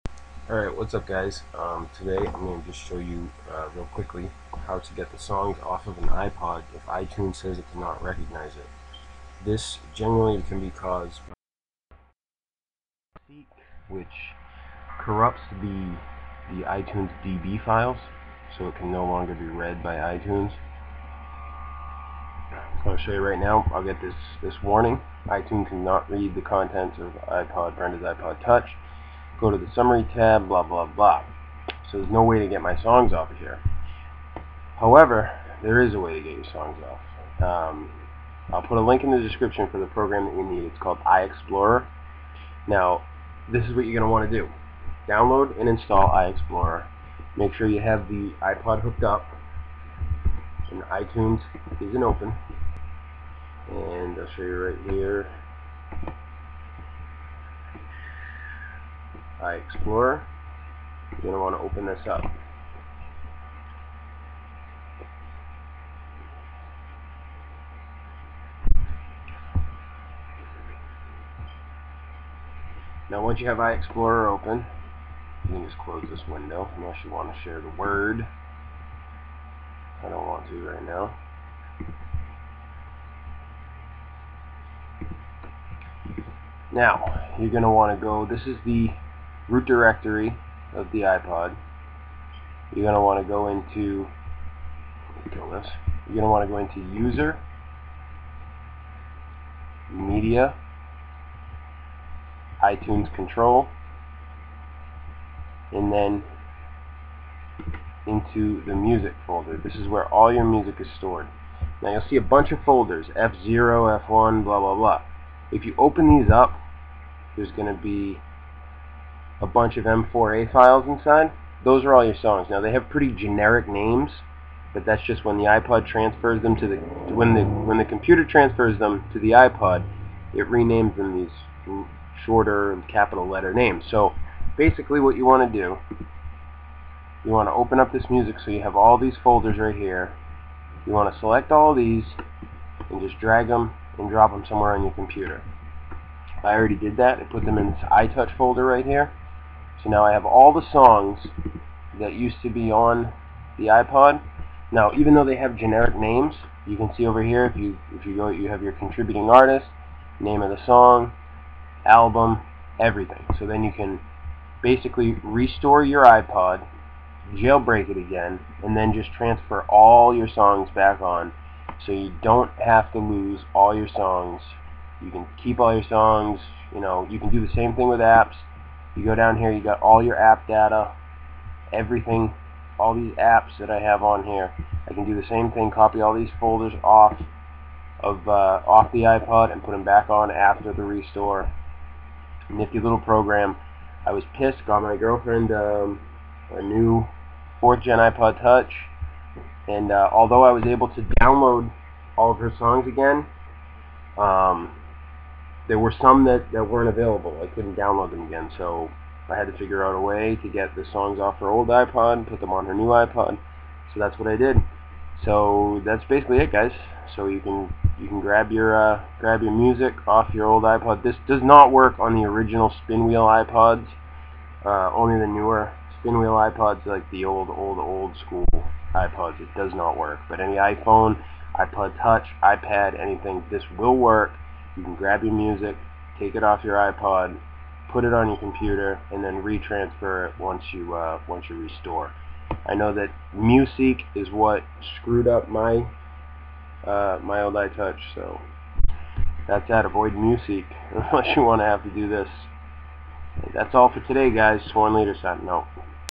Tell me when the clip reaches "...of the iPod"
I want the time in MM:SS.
01:30.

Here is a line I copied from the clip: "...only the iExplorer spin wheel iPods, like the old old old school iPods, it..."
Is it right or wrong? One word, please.
wrong.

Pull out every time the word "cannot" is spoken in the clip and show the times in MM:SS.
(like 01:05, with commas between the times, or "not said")
00:07, 00:25.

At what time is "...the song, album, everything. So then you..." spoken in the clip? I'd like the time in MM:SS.
02:40.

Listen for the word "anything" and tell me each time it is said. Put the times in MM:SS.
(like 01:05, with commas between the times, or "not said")
03:52.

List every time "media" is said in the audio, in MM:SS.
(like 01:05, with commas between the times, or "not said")
01:39.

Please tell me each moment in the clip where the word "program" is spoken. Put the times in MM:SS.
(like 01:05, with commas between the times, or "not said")
00:39, 03:12.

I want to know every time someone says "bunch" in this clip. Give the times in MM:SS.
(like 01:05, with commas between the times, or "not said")
01:52, 01:59.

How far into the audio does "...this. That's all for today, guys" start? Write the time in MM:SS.
04:12.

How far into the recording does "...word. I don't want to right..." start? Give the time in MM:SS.
01:17.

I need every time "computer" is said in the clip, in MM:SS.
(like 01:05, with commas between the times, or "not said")
02:07, 02:24, 03:58.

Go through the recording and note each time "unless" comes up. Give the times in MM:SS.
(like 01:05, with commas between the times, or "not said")
01:16, 04:11.